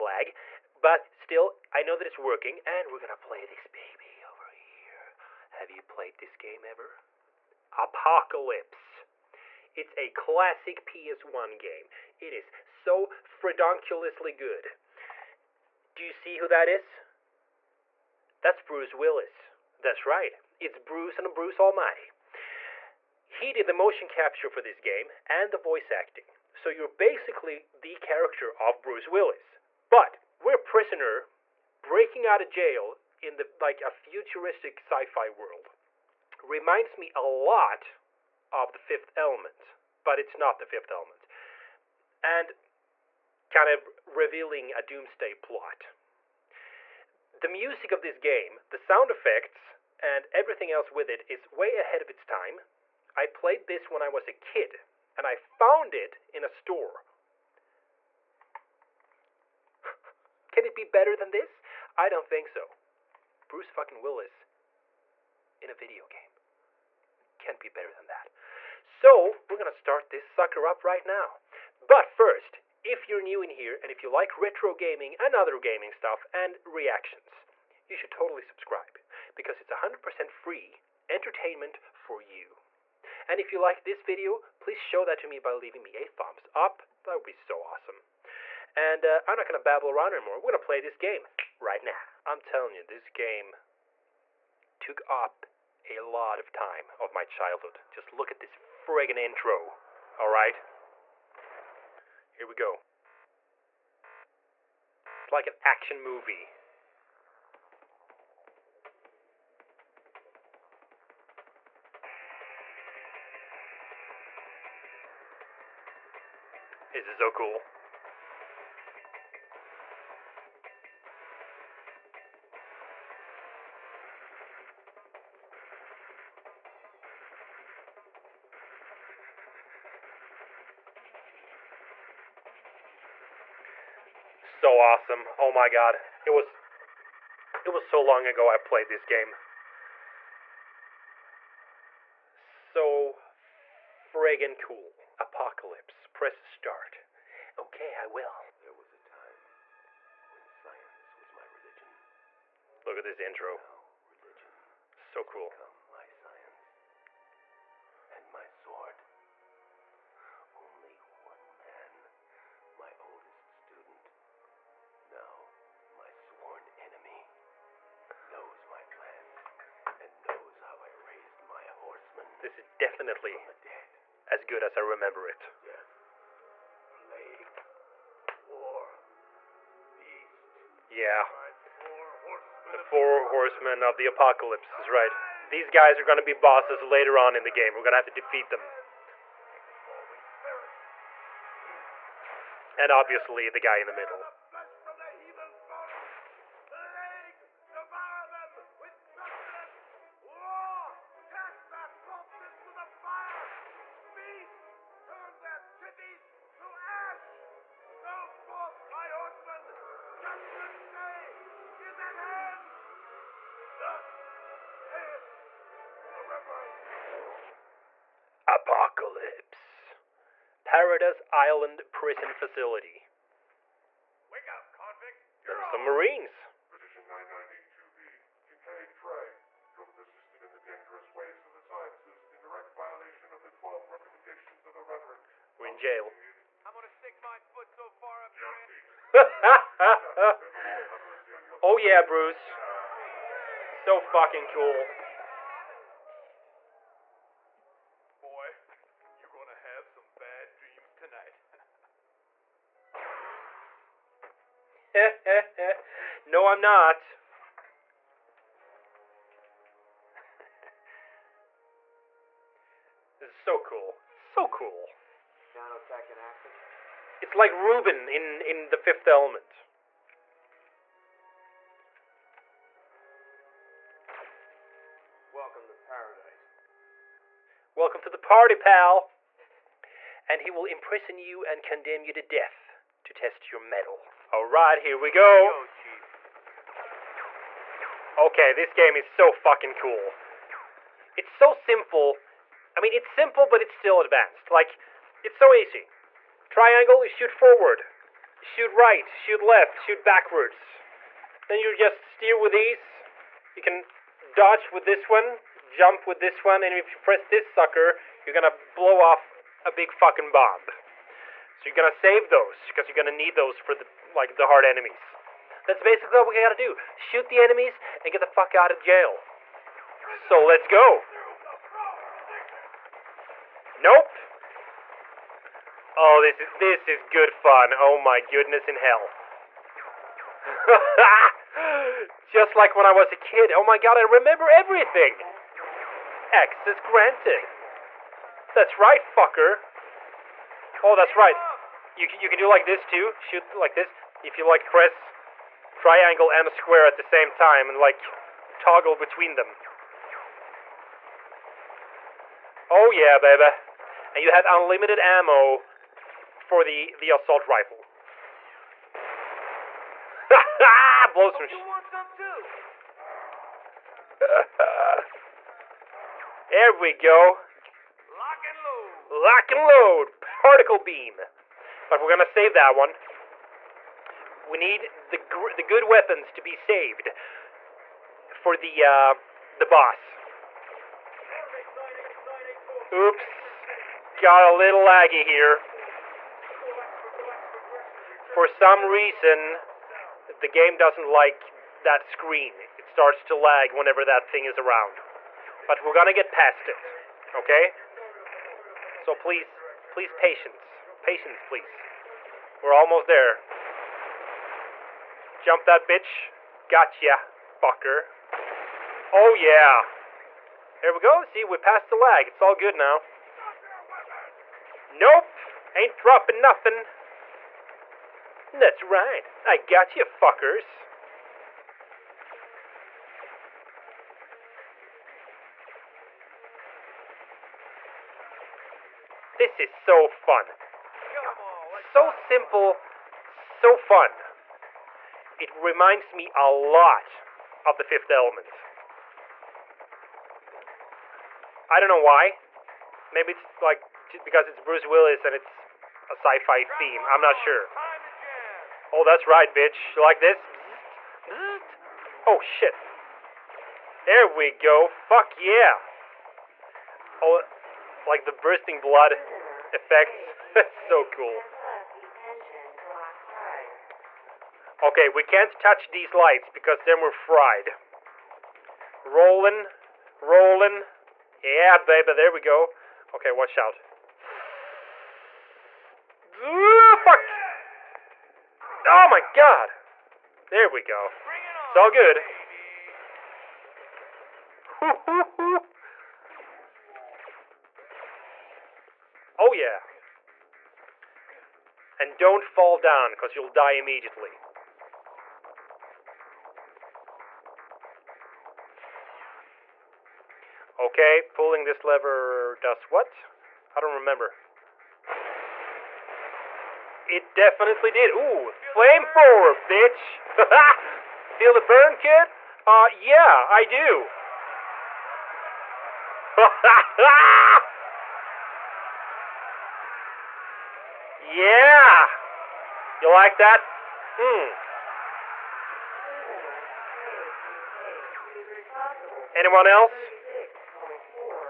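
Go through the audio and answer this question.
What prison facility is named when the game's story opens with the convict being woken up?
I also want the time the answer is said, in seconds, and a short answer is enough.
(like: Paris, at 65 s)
Paradise Island prison facility, at 220 s.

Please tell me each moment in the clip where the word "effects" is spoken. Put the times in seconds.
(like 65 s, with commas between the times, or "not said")
49 s, 459 s.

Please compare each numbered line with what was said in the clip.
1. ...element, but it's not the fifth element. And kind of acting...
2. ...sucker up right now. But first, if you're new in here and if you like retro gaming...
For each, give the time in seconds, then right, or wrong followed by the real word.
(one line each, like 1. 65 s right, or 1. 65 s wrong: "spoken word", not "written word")
1. 39 s wrong: "revealing", not "acting"
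2. 70 s right.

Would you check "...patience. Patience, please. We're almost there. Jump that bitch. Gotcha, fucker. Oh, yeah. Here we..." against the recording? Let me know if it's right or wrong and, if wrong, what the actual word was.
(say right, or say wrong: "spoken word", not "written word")
right.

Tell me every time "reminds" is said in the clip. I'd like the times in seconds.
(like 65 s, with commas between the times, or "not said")
36 s, 435 s.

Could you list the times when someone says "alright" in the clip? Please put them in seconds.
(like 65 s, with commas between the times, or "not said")
100 s, 284 s.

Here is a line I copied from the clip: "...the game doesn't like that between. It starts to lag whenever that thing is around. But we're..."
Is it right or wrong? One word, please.
wrong.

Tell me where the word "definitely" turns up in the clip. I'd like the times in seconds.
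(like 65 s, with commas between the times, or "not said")
172 s, 507 s.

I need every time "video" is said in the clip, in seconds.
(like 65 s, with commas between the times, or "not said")
65 s, 84 s.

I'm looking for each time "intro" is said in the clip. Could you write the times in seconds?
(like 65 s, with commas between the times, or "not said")
99 s, 153 s.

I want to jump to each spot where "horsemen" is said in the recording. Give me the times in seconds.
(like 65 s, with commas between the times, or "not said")
171 s, 183 s.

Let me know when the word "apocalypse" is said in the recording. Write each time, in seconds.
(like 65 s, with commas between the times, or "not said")
7 s, 145 s, 184 s.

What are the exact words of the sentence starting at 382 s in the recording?
Oops, got a little laggy here.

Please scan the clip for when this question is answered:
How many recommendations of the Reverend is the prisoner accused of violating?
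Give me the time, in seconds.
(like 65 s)
233 s.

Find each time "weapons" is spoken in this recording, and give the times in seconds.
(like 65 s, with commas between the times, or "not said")
375 s.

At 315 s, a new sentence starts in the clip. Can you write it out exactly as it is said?
That's basically what we gotta do.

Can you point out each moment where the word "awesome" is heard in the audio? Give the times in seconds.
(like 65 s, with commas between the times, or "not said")
87 s, 134 s.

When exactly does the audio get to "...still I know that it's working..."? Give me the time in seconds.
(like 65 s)
1 s.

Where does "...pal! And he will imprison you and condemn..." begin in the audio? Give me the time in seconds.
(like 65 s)
278 s.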